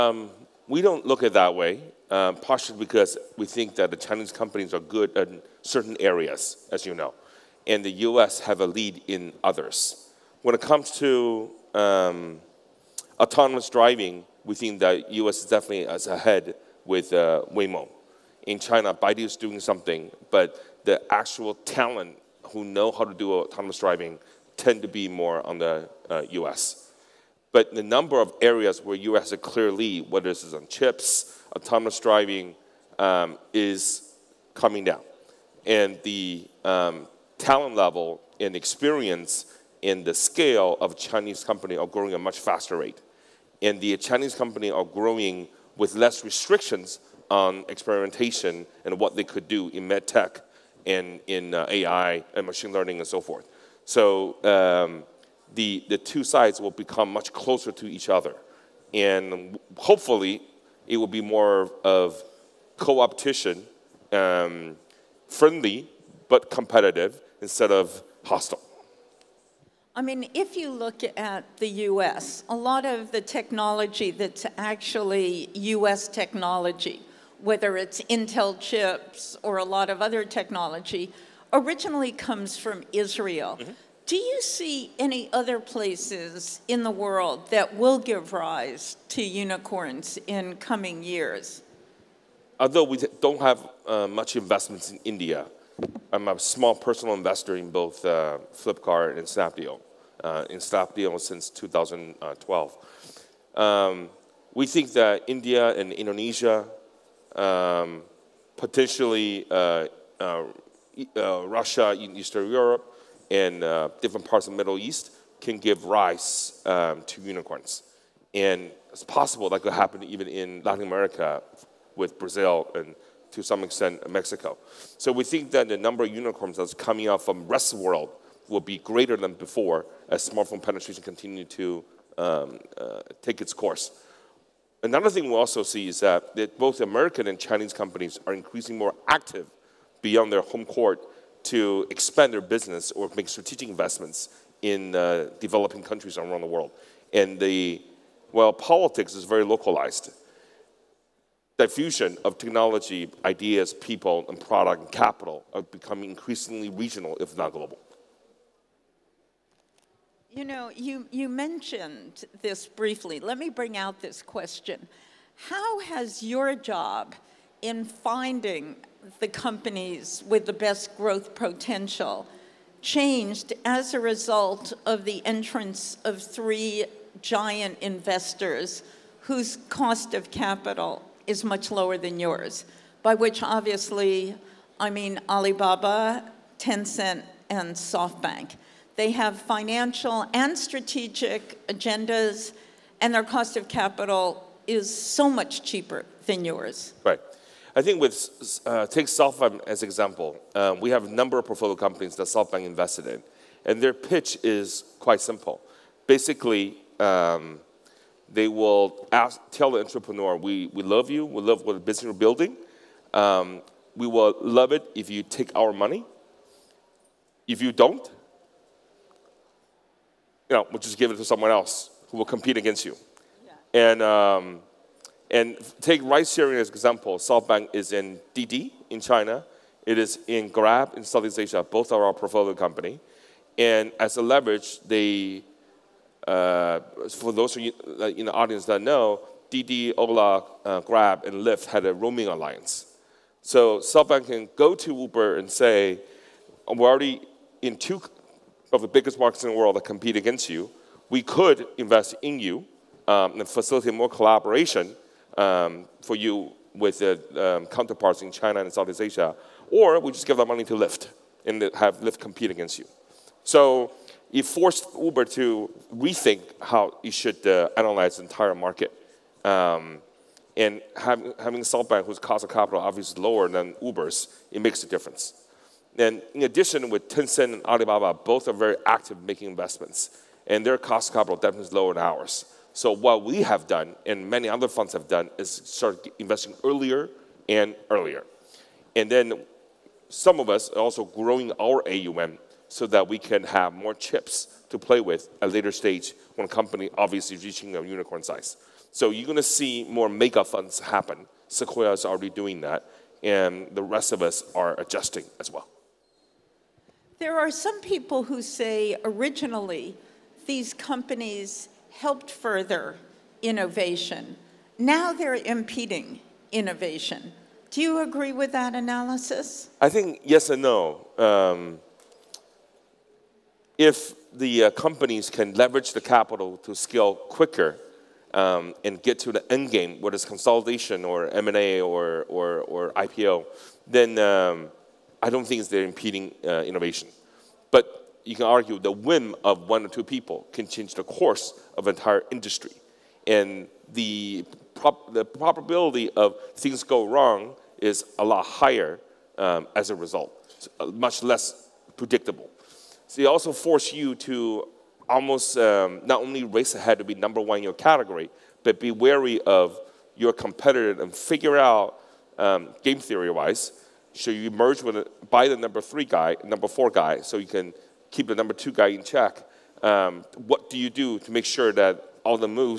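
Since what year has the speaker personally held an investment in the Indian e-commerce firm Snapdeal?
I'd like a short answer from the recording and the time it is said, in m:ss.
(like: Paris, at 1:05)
2012, at 1:41.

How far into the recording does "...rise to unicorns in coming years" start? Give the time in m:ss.
1:28.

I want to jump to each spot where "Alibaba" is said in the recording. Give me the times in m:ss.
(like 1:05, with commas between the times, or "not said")
3:05, 4:37.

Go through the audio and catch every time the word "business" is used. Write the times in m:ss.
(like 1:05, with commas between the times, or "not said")
2:22, 3:31.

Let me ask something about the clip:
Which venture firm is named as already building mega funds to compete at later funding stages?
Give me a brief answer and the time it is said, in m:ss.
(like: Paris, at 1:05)
Sequoia, at 5:01.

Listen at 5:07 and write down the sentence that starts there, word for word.
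There are some people who say originally these companies helped further innovation.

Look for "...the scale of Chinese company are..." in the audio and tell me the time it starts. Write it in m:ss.
0:40.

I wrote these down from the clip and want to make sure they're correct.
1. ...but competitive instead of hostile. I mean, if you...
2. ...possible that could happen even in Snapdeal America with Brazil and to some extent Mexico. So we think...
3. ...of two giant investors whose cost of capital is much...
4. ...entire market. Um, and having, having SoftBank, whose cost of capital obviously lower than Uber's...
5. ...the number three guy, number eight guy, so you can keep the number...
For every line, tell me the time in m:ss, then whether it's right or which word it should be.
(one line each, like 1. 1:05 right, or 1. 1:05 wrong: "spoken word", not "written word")
1. 1:06 right
2. 1:59 wrong: "Latin", not "Snapdeal"
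3. 2:56 wrong: "three", not "two"
4. 4:28 right
5. 6:05 wrong: "four", not "eight".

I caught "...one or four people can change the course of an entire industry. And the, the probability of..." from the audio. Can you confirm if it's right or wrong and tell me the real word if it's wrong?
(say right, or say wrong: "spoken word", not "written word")
wrong: "two", not "four".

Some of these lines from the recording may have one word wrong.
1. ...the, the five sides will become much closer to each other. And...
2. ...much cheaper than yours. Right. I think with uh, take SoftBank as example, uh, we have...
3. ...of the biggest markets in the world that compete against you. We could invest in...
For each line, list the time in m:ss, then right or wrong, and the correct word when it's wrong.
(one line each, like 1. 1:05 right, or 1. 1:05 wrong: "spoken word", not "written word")
1. 0:55 wrong: "two", not "five"
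2. 3:15 right
3. 4:08 right.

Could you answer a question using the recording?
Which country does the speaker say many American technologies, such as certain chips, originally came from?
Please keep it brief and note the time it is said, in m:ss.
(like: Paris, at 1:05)
Israel, at 1:22.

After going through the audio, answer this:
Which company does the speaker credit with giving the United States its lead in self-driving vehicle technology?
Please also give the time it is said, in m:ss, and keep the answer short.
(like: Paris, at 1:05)
Waymo, at 0:17.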